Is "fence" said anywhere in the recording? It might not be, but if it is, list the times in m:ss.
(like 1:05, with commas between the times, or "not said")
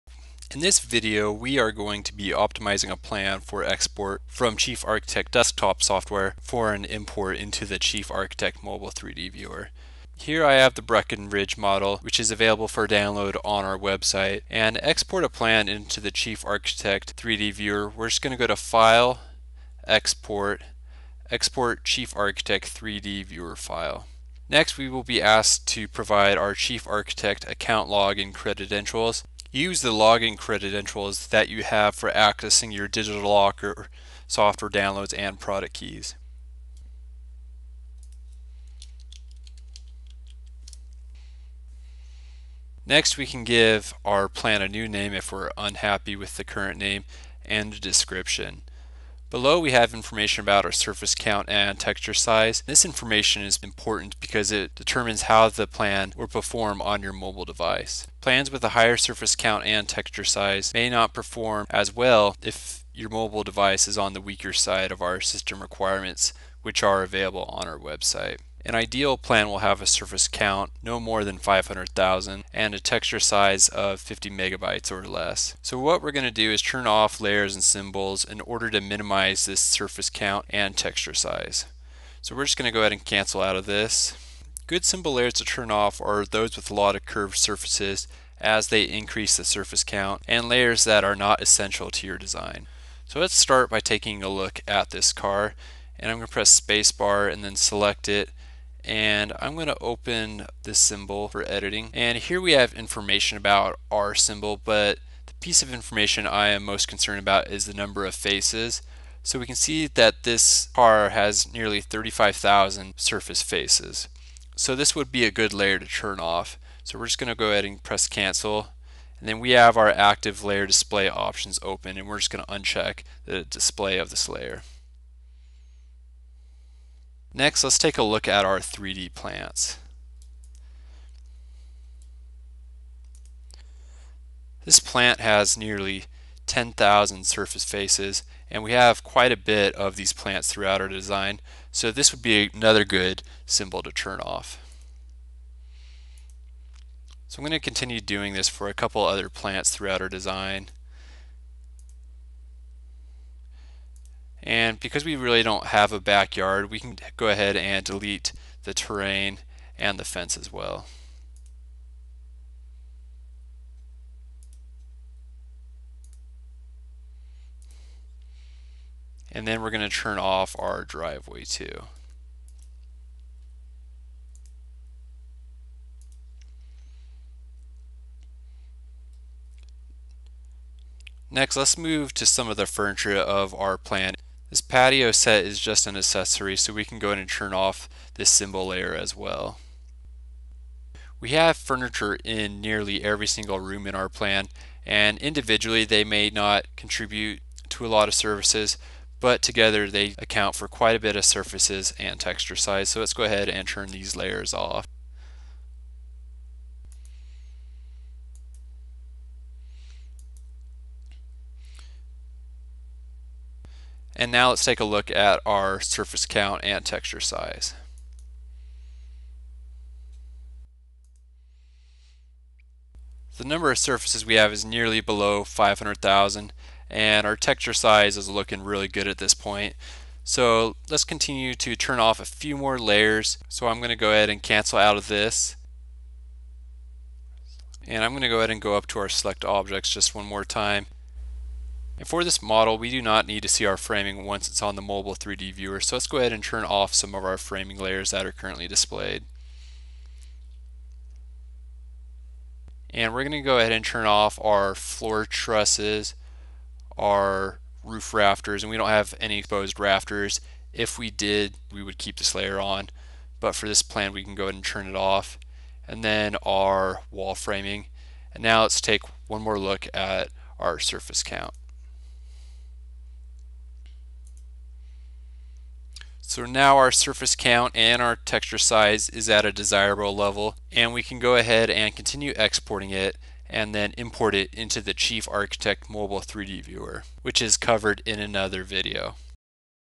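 2:40.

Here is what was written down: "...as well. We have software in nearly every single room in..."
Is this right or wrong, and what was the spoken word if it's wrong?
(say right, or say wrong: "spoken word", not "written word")
wrong: "furniture", not "software".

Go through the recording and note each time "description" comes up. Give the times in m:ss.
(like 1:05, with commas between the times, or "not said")
0:47.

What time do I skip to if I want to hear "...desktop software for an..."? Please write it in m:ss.
0:05.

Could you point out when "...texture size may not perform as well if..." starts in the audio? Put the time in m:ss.
0:59.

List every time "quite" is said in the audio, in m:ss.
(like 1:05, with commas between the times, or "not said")
2:19, 3:20.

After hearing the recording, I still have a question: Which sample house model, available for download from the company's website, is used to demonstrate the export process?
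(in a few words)
Breckenridge.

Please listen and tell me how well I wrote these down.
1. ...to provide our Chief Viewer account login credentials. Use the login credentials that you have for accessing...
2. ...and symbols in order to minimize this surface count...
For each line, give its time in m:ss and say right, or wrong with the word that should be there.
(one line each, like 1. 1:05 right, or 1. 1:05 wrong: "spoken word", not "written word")
1. 0:25 wrong: "Architect", not "Viewer"
2. 1:17 right.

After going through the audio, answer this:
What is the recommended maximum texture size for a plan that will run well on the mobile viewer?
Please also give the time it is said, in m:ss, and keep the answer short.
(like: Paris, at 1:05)
50 megabytes, at 1:13.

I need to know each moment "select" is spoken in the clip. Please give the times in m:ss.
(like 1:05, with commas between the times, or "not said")
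1:37, 3:59.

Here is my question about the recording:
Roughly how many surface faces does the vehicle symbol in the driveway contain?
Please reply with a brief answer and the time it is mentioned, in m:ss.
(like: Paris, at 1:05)
35,000, at 1:51.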